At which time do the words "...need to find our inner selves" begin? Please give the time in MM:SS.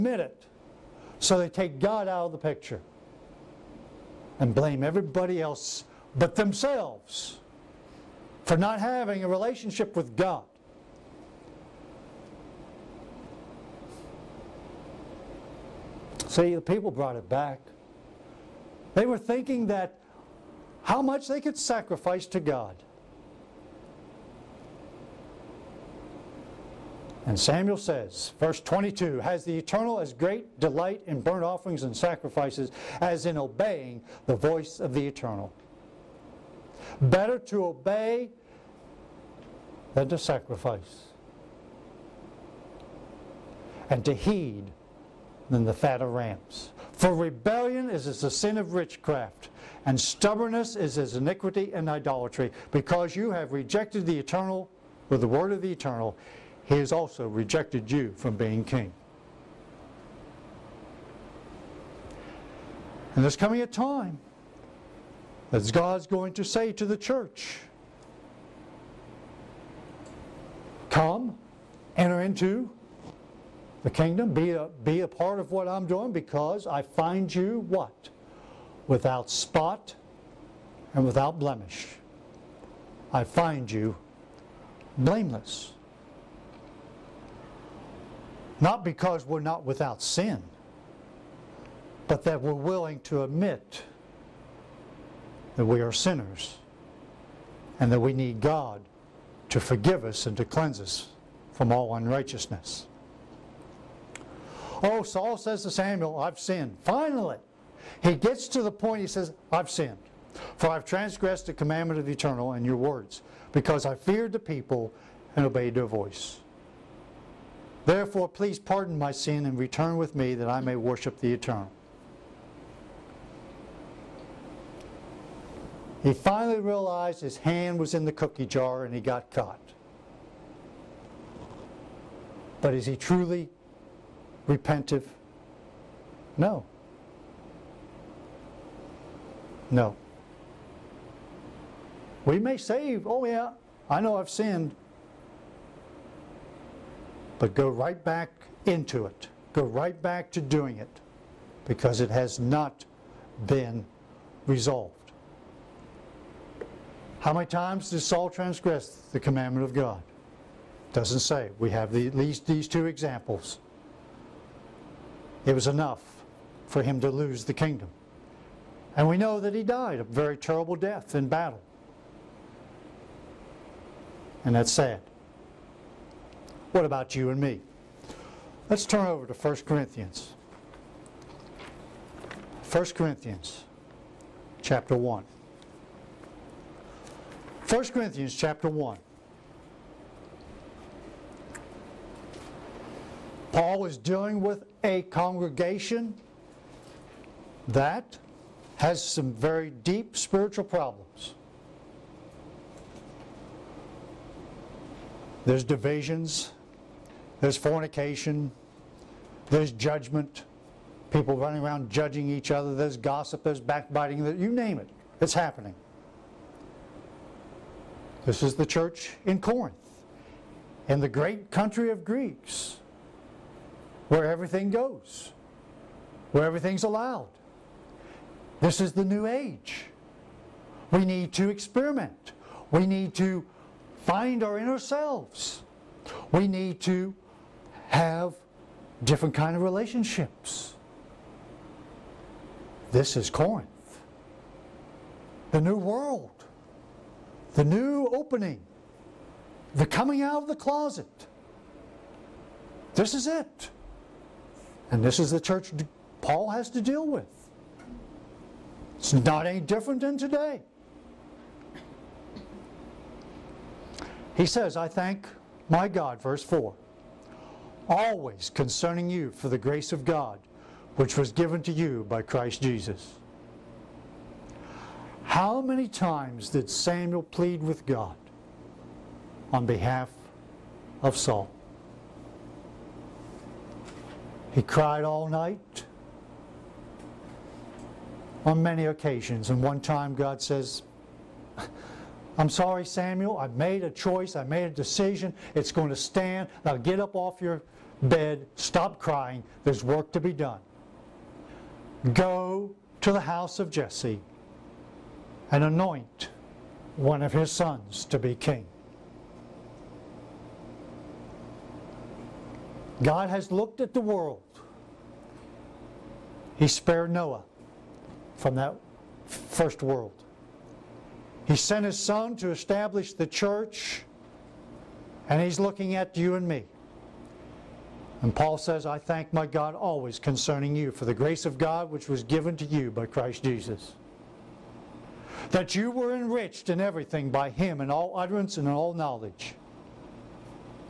03:52.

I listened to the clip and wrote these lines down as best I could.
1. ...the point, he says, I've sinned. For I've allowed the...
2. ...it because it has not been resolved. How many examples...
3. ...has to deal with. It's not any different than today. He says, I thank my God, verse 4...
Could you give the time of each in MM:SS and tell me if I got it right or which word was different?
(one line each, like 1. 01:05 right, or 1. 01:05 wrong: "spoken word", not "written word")
1. 01:48 wrong: "transgressed", not "allowed"
2. 02:30 wrong: "times", not "examples"
3. 04:16 right.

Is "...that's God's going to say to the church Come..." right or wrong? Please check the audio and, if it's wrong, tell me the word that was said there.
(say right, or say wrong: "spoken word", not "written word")
right.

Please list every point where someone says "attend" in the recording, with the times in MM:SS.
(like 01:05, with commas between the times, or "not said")
not said.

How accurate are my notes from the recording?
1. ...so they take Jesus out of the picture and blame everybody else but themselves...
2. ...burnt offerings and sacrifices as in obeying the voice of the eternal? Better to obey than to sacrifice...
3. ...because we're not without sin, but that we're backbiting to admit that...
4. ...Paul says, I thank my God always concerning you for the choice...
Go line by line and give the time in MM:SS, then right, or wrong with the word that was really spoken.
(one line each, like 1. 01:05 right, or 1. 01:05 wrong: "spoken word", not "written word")
1. 00:01 wrong: "God", not "Jesus"
2. 00:31 right
3. 01:28 wrong: "willing", not "backbiting"
4. 05:28 wrong: "grace", not "choice".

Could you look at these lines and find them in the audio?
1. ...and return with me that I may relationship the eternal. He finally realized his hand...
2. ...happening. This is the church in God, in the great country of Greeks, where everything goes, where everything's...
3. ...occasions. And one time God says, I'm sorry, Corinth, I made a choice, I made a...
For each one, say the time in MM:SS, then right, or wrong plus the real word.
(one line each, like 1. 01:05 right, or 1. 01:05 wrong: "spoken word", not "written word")
1. 01:59 wrong: "worship", not "relationship"
2. 03:35 wrong: "Corinth", not "God"
3. 04:48 wrong: "Samuel", not "Corinth".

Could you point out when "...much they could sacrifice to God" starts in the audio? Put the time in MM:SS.
00:21.